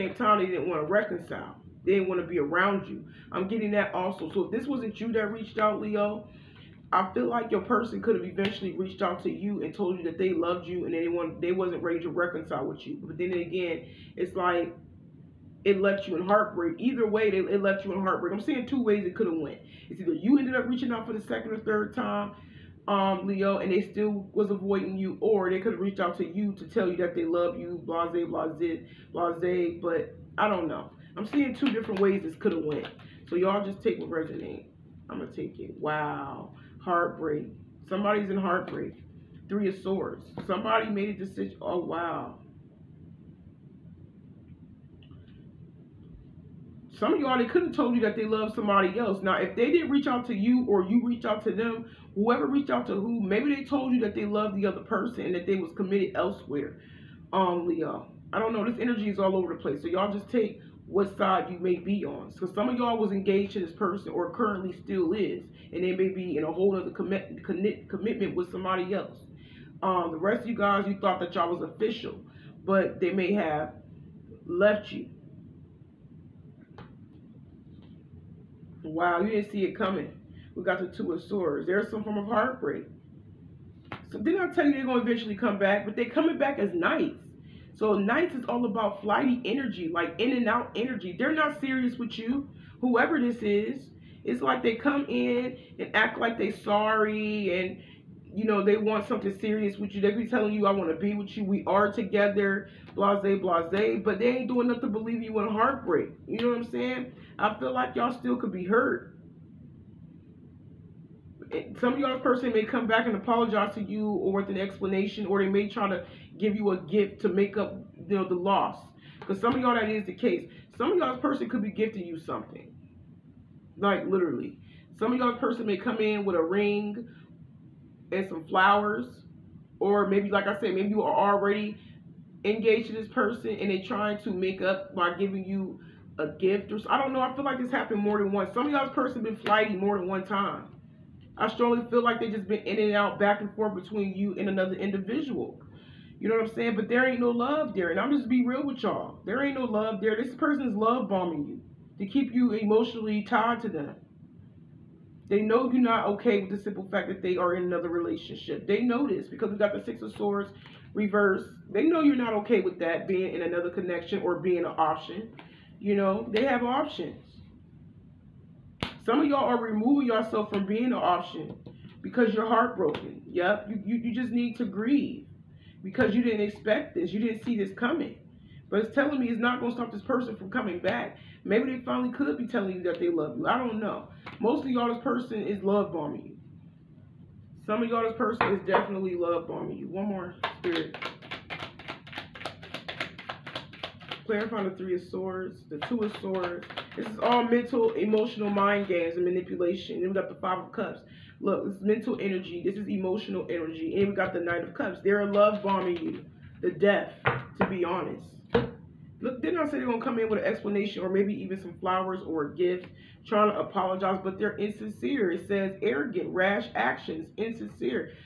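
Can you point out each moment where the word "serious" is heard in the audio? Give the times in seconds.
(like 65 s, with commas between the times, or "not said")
91 s, 99 s.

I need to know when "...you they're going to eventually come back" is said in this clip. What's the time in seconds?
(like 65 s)
84 s.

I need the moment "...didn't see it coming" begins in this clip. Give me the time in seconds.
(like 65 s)
79 s.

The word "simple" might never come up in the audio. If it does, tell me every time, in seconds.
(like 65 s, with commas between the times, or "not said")
156 s.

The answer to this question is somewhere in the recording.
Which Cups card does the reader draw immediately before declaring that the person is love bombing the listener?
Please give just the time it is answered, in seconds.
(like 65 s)
204 s.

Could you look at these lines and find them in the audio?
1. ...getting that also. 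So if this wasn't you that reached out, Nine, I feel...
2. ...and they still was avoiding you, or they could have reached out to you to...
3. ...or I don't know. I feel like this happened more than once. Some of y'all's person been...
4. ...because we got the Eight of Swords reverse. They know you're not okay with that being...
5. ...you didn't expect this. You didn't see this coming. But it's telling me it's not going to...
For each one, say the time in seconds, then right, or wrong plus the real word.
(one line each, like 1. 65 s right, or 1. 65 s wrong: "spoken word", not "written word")
1. 3 s wrong: "Leo", not "Nine"
2. 23 s right
3. 136 s right
4. 159 s wrong: "Six", not "Eight"
5. 176 s right.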